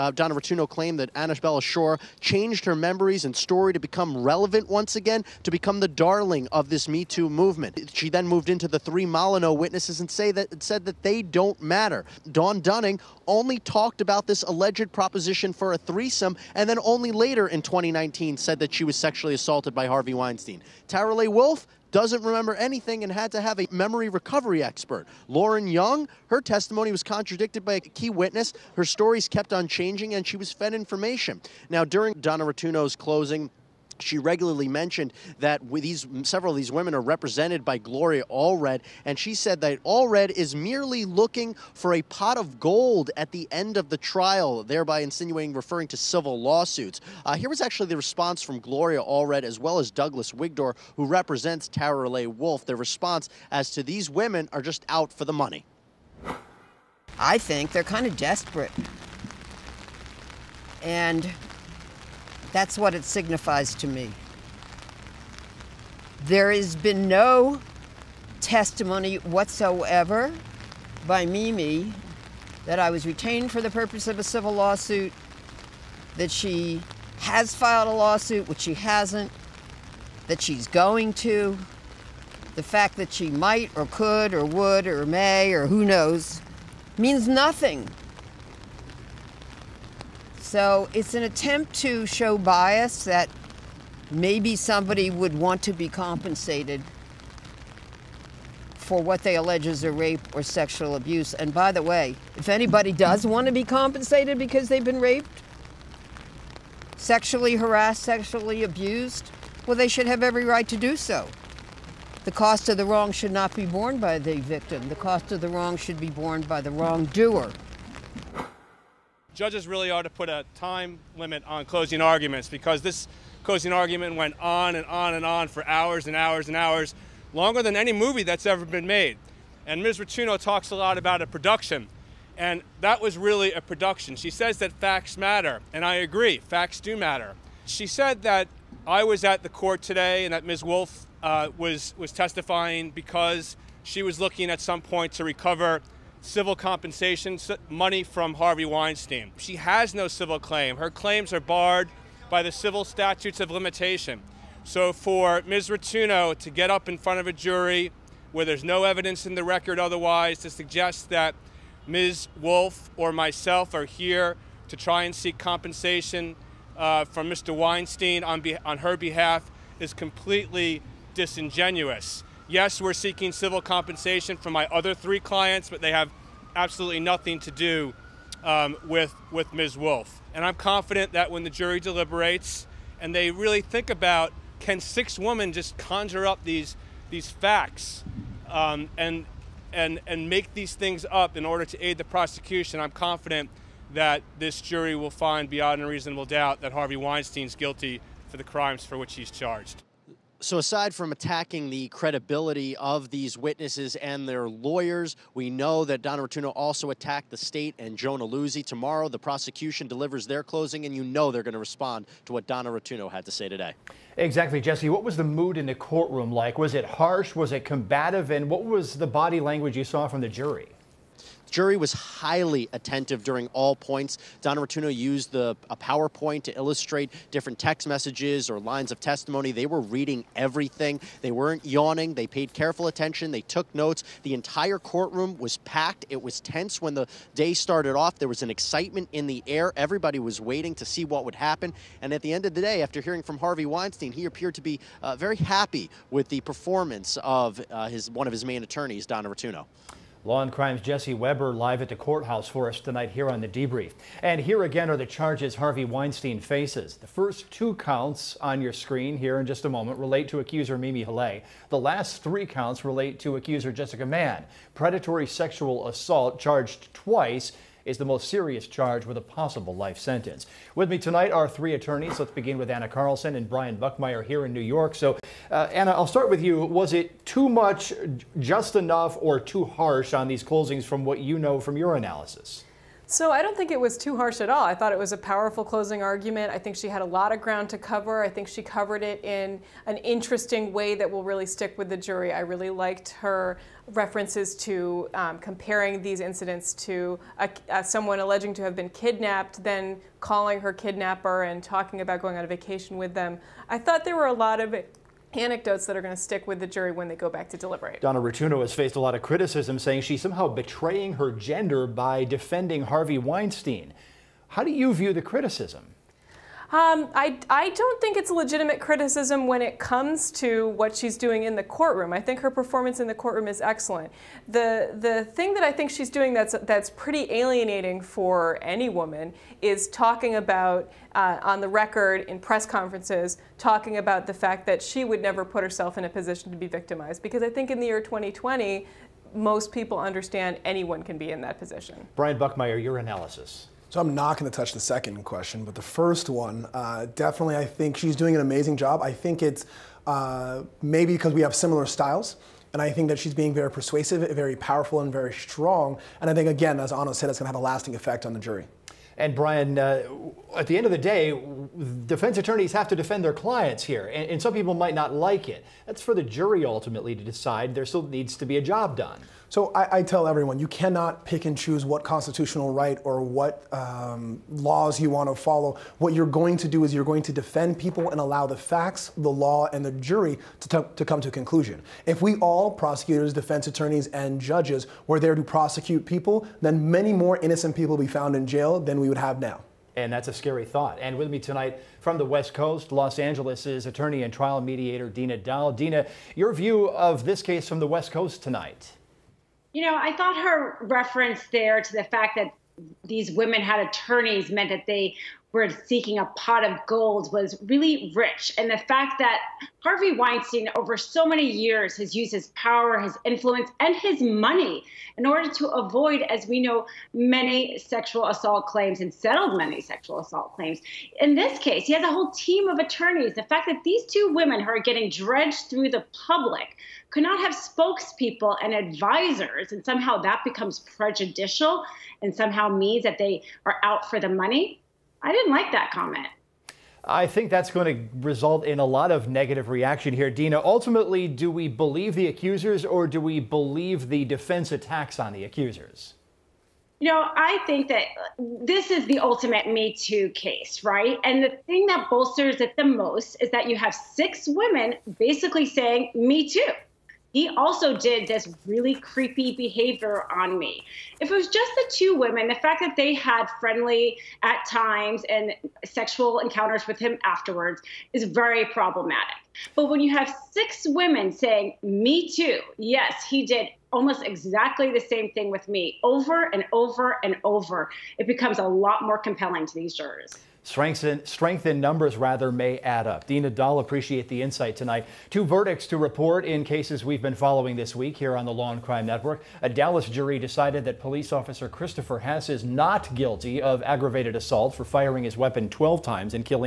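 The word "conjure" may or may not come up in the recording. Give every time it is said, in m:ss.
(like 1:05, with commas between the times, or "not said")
3:05.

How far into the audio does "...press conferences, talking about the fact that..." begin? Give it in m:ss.
5:32.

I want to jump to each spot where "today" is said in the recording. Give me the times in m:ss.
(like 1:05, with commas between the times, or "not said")
2:19, 3:33.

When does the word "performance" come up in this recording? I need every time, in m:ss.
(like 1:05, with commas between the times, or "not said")
4:06, 5:22.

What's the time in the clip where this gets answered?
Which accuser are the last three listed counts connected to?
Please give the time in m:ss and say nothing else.
4:23.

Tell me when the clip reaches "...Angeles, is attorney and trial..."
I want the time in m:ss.
6:33.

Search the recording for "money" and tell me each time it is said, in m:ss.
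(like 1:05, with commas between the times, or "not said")
0:55, 2:27, 6:54, 7:14.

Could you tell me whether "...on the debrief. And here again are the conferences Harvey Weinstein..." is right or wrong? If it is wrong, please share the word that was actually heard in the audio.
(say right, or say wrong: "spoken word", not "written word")
wrong: "charges", not "conferences".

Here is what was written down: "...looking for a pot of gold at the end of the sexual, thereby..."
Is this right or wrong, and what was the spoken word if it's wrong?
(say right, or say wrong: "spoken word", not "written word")
wrong: "trial", not "sexual".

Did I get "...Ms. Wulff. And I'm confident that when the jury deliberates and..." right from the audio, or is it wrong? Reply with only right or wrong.
right.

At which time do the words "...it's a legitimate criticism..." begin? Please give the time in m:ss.
5:18.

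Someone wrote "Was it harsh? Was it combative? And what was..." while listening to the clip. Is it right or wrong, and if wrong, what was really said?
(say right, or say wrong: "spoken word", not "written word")
right.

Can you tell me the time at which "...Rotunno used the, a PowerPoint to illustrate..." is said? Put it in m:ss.
3:44.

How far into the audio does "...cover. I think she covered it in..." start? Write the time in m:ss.
4:47.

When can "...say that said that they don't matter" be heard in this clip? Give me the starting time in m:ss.
0:10.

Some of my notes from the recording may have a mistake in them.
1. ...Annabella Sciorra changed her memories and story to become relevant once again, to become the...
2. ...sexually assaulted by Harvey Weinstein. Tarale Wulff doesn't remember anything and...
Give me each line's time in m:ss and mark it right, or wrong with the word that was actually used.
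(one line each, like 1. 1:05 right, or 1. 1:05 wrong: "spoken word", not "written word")
1. 0:01 right
2. 0:18 right.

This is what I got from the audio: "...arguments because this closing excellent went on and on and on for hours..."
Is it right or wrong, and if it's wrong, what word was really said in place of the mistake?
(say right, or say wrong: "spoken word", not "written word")
wrong: "argument", not "excellent".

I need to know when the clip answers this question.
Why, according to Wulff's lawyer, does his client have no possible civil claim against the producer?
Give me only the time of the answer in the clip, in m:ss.
2:32.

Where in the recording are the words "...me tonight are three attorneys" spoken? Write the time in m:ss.
4:30.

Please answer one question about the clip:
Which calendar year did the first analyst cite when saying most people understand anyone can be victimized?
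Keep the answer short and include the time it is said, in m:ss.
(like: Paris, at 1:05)
2020, at 5:38.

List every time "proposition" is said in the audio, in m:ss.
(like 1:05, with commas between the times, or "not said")
0:14.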